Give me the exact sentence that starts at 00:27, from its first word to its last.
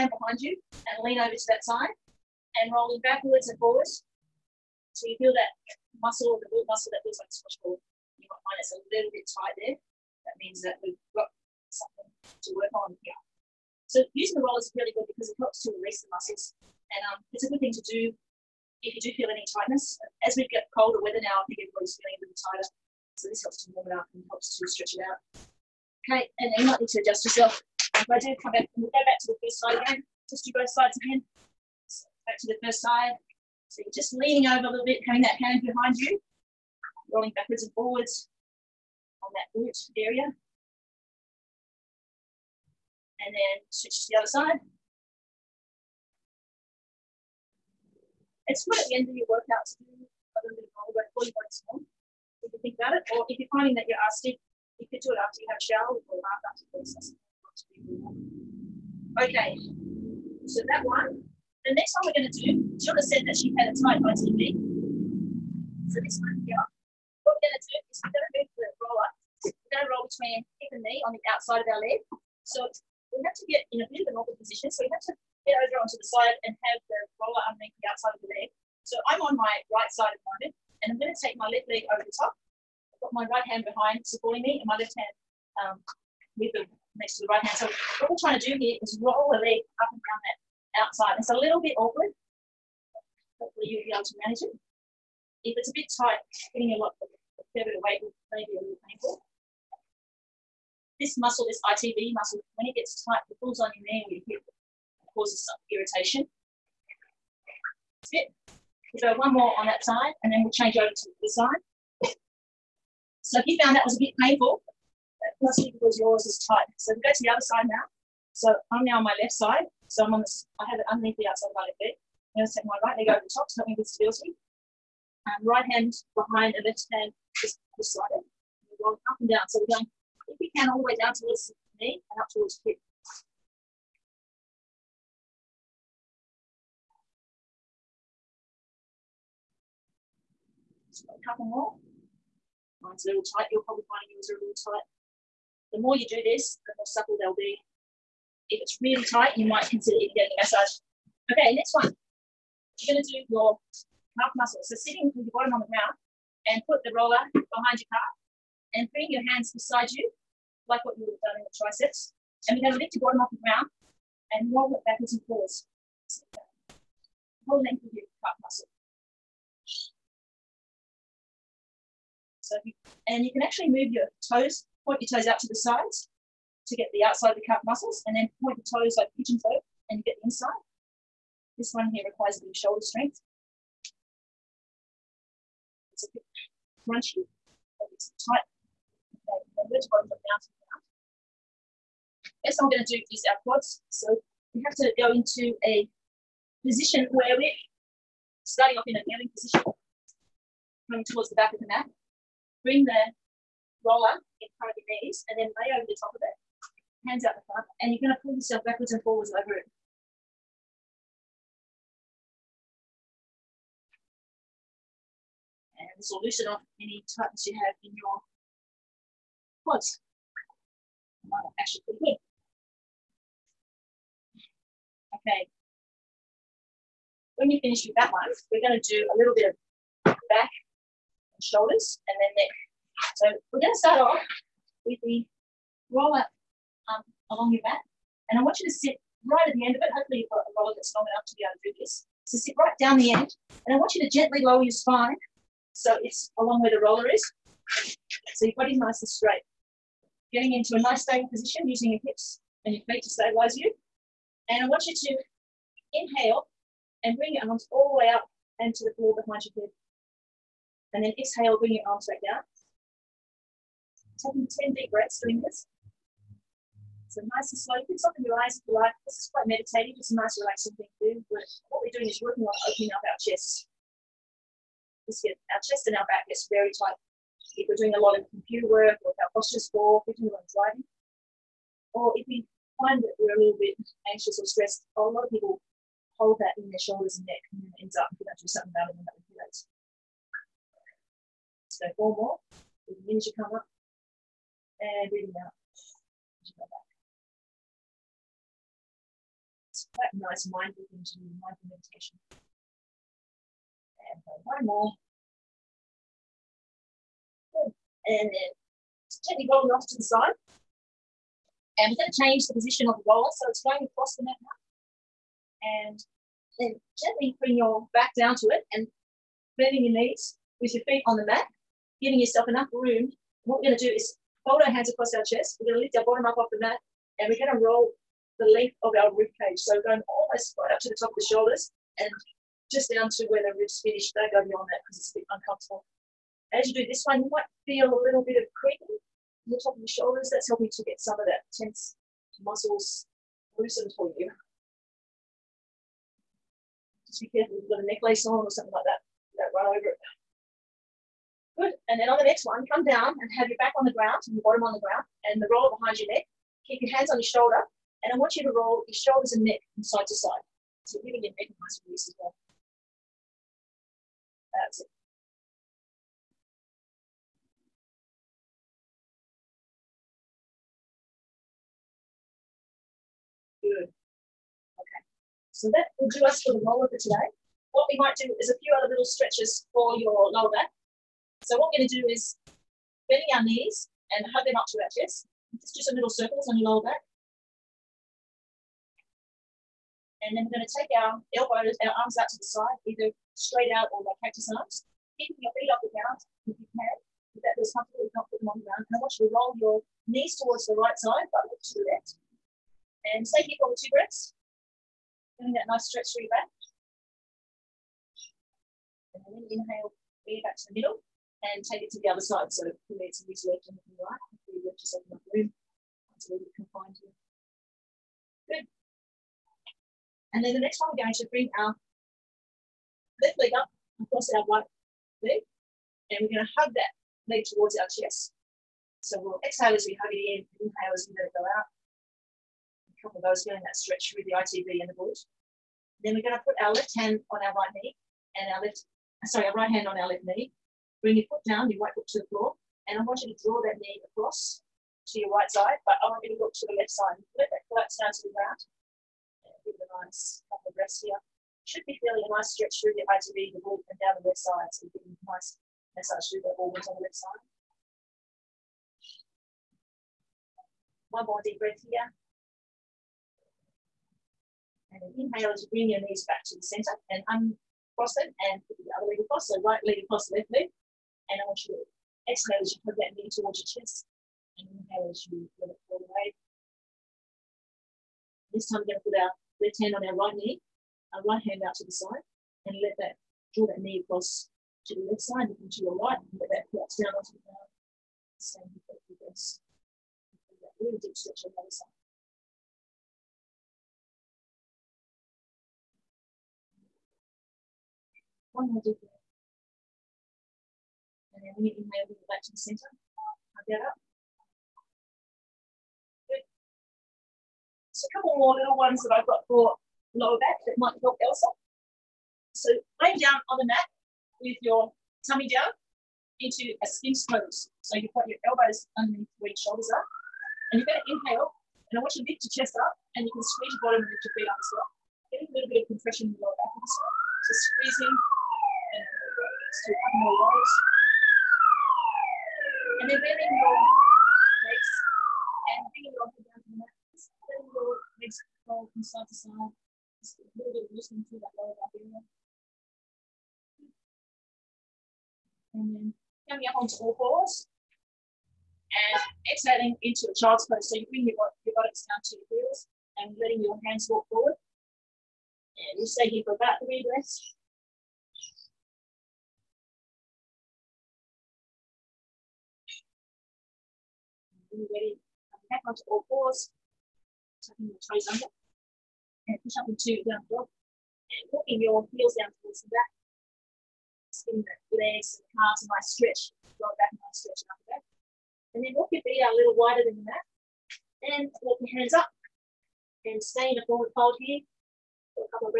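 If I do come back, and we'll go back to the first side again.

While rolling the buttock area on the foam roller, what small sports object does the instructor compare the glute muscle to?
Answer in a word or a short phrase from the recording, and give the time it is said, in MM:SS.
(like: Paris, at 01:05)
a squash ball, at 00:07.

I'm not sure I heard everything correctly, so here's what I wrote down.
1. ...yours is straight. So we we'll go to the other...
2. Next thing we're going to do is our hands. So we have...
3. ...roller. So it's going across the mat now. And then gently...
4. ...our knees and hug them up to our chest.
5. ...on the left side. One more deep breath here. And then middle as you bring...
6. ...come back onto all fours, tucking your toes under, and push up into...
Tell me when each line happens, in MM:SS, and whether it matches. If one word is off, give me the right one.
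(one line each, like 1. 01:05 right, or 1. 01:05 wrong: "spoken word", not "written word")
1. 01:55 wrong: "tight", not "straight"
2. 03:12 wrong: "quads", not "hands"
3. 05:13 right
4. 06:23 right
5. 07:36 wrong: "inhale", not "middle"
6. 09:25 right.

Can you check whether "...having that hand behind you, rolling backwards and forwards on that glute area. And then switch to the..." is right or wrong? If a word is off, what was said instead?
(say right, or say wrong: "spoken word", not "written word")
right.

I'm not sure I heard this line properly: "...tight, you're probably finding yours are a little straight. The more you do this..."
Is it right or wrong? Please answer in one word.
wrong.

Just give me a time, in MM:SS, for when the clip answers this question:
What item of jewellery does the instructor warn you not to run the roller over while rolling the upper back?
05:47.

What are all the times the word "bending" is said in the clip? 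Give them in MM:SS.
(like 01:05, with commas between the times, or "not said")
05:19, 06:23.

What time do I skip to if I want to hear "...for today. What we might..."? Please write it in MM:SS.
06:16.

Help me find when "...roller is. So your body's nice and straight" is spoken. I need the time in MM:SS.
04:06.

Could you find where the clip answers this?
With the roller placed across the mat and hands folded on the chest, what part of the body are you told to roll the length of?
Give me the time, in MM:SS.
05:29.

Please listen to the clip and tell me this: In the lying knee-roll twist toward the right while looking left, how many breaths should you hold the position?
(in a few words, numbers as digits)
2.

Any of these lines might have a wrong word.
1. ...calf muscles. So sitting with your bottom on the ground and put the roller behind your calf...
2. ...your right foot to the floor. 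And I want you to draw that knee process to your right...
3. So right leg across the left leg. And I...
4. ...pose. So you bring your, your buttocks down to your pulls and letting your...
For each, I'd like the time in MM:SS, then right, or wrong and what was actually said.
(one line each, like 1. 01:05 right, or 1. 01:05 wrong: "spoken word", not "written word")
1. 02:34 right
2. 07:21 wrong: "across", not "process"
3. 07:49 right
4. 09:10 wrong: "heels", not "pulls".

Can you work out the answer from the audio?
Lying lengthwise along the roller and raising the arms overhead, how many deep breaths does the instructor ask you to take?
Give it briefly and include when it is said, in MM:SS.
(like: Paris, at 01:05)
10, at 04:24.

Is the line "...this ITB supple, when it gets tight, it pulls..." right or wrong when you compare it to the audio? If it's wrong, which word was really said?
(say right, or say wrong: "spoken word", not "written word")
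wrong: "muscle", not "supple".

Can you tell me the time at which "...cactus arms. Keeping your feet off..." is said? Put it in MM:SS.
06:34.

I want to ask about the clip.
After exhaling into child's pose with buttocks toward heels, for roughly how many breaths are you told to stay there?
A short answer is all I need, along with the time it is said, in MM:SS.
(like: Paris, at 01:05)
3, at 09:16.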